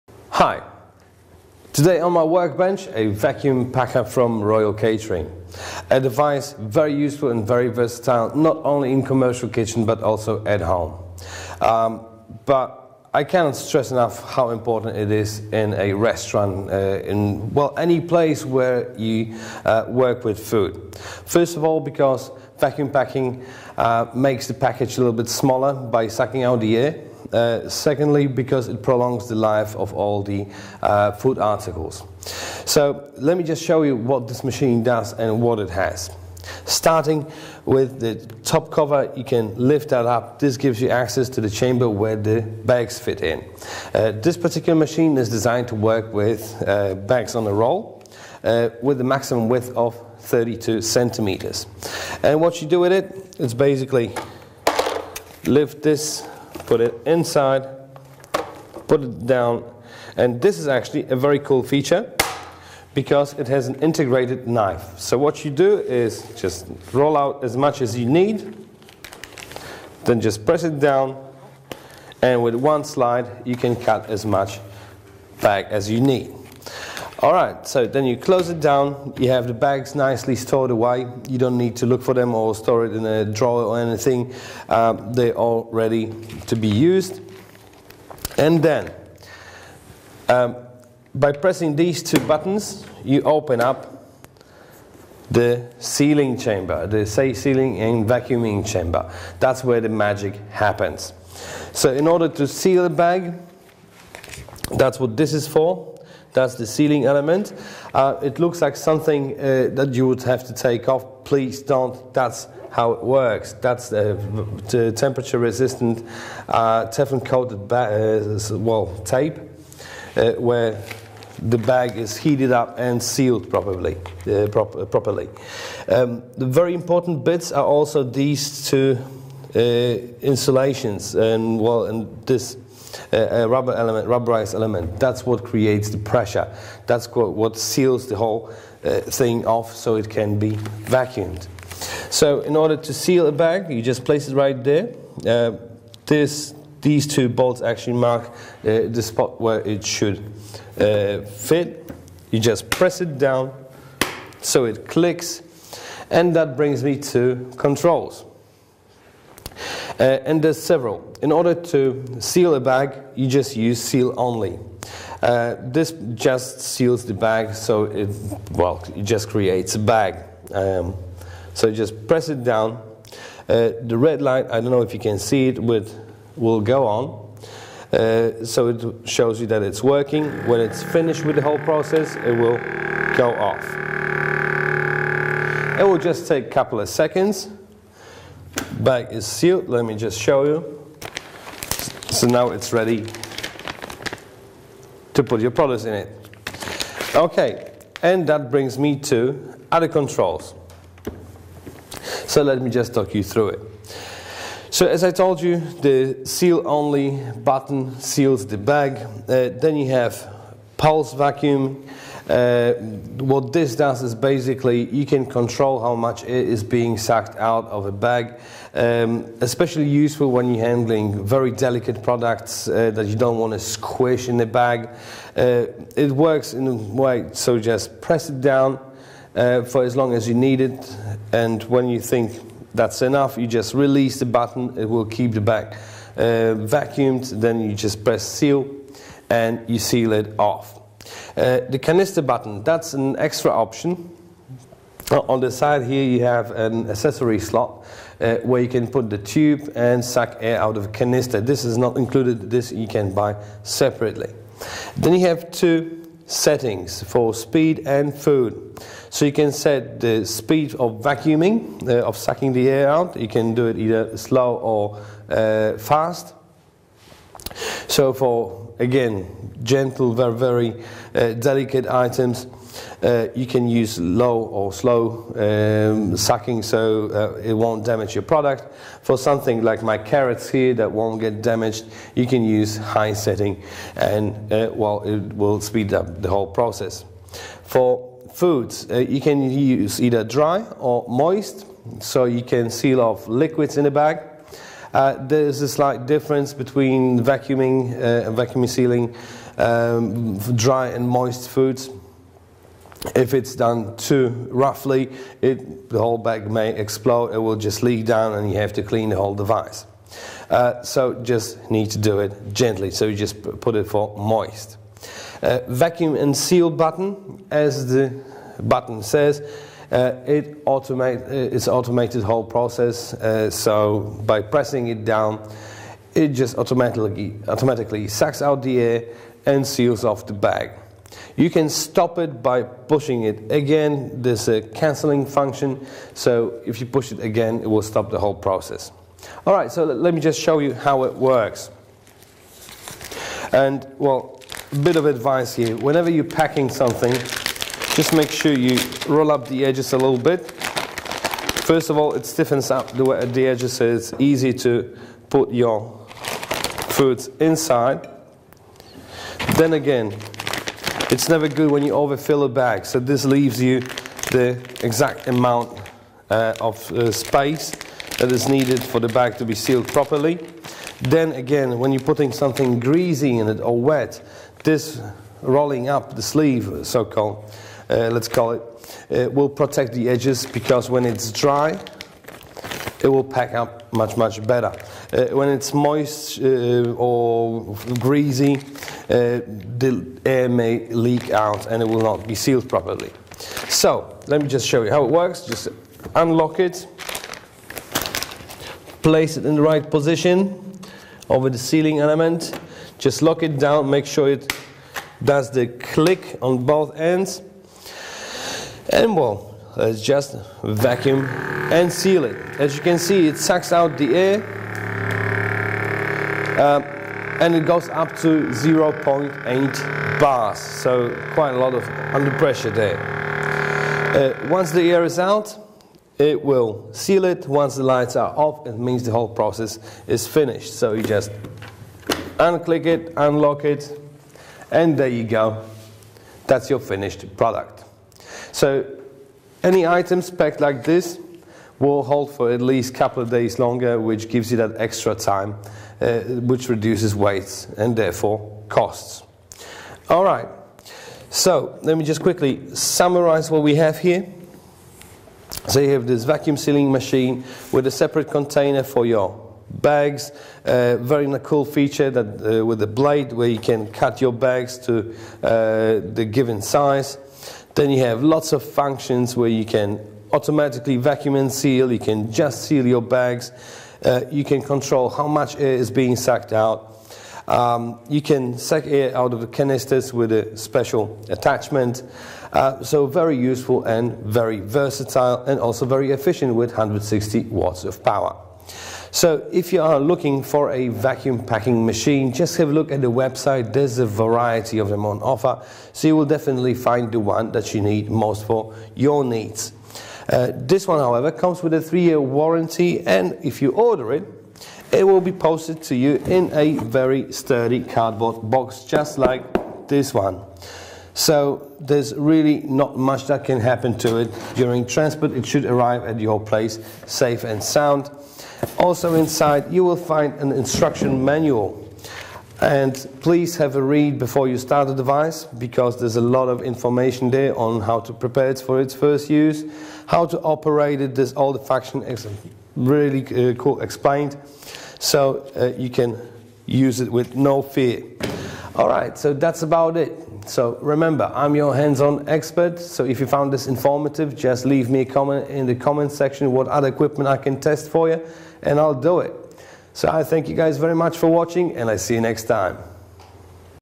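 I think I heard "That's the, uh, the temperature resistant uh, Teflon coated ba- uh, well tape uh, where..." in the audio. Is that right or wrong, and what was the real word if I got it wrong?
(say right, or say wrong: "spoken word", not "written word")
right.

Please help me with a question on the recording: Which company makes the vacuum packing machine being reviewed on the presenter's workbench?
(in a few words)
Royal Catering.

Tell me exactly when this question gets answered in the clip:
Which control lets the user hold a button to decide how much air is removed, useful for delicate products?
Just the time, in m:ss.
3:30.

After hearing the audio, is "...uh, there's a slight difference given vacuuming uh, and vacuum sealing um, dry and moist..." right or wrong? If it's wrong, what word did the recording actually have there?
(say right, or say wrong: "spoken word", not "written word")
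wrong: "between", not "given".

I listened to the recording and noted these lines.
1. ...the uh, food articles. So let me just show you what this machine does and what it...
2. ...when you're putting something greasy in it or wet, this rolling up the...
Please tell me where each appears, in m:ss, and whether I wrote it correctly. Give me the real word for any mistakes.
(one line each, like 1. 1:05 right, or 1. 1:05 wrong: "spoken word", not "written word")
1. 0:30 right
2. 6:11 right.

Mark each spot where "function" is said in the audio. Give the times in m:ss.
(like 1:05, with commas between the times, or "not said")
5:35, 7:48, 8:51.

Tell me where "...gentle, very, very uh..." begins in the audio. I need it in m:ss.
4:29.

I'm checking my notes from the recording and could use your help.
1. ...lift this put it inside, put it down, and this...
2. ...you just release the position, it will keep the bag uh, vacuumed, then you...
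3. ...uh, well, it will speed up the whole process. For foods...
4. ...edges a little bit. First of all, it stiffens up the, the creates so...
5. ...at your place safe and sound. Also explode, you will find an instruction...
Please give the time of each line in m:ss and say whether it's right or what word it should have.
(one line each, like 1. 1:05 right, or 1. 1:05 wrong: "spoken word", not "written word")
1. 0:55 right
2. 3:53 wrong: "button", not "position"
3. 4:44 right
4. 5:49 wrong: "edges", not "creates"
5. 8:36 wrong: "inside", not "explode".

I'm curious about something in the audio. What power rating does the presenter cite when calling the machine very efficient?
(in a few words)
160 watts.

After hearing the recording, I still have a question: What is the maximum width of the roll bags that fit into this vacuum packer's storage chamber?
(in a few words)
32 centimeters.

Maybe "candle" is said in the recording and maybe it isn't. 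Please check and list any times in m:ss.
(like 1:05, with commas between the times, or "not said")
not said.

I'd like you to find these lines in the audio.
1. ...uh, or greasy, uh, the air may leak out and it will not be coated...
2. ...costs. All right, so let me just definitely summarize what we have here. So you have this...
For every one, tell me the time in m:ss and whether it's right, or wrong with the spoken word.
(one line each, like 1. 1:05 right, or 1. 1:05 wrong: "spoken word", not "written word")
1. 6:26 wrong: "sealed", not "coated"
2. 7:28 wrong: "quickly", not "definitely".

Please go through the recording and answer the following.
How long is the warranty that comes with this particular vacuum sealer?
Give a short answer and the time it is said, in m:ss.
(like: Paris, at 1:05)
3 years, at 8:21.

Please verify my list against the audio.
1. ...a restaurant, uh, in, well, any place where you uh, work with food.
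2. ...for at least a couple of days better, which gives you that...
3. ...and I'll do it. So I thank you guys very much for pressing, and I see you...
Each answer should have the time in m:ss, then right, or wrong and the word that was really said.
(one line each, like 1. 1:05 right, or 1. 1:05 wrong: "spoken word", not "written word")
1. 0:15 right
2. 7:22 wrong: "longer", not "better"
3. 9:08 wrong: "watching", not "pressing".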